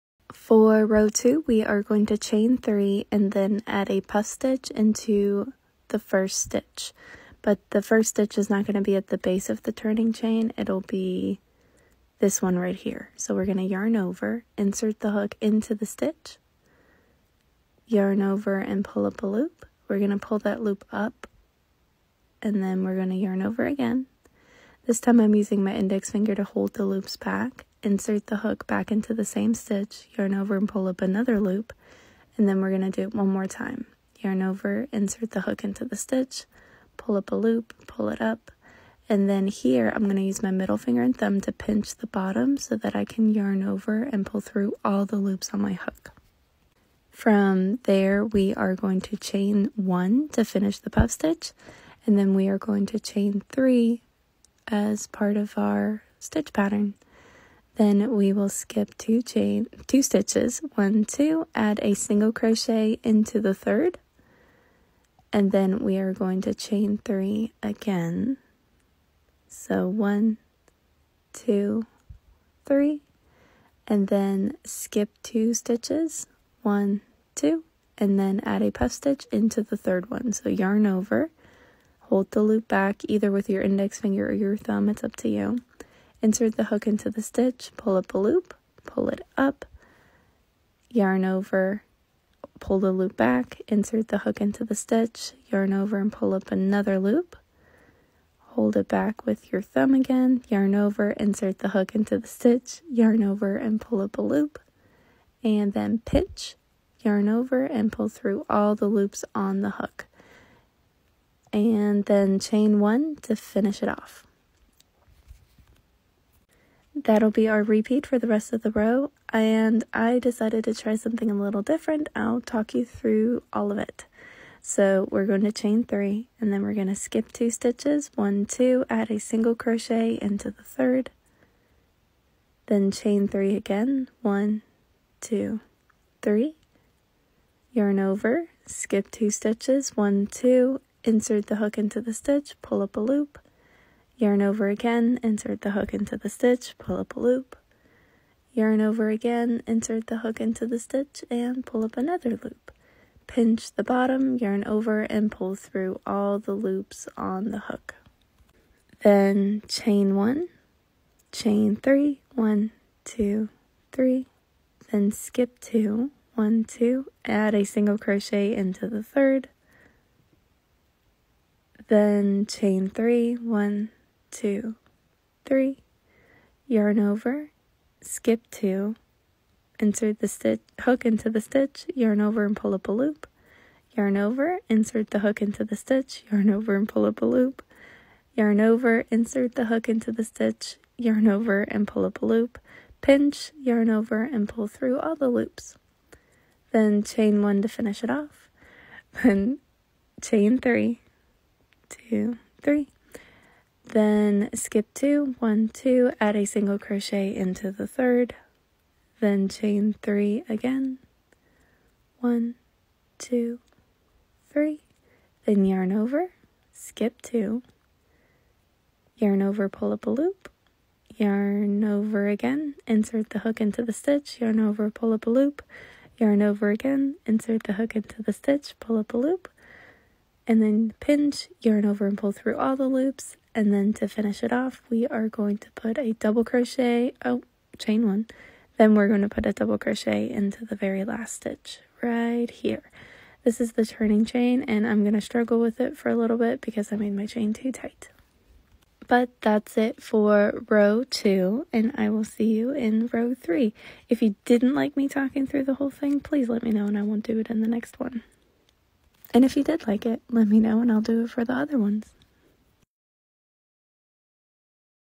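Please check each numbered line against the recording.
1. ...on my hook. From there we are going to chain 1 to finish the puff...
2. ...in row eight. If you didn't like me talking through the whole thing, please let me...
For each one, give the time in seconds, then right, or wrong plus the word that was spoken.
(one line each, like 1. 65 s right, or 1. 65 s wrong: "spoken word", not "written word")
1. 45 s right
2. 252 s wrong: "three", not "eight".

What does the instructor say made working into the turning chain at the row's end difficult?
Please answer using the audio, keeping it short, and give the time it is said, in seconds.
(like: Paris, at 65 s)
chain too tight, at 247 s.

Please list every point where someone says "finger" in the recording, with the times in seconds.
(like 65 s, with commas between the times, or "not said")
26 s, 40 s, 84 s.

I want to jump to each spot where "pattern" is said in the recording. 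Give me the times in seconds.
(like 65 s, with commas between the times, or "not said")
56 s.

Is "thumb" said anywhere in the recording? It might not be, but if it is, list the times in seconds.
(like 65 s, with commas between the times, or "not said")
41 s, 84 s, 99 s.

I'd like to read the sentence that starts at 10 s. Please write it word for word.
It'll be this one right here.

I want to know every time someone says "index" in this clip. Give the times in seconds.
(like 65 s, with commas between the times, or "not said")
25 s, 83 s.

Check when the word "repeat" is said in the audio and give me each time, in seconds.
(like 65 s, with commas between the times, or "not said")
117 s.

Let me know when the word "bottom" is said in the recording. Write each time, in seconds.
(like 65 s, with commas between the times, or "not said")
42 s, 153 s.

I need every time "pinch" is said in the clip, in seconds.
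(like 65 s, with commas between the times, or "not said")
41 s, 106 s, 153 s, 193 s, 230 s.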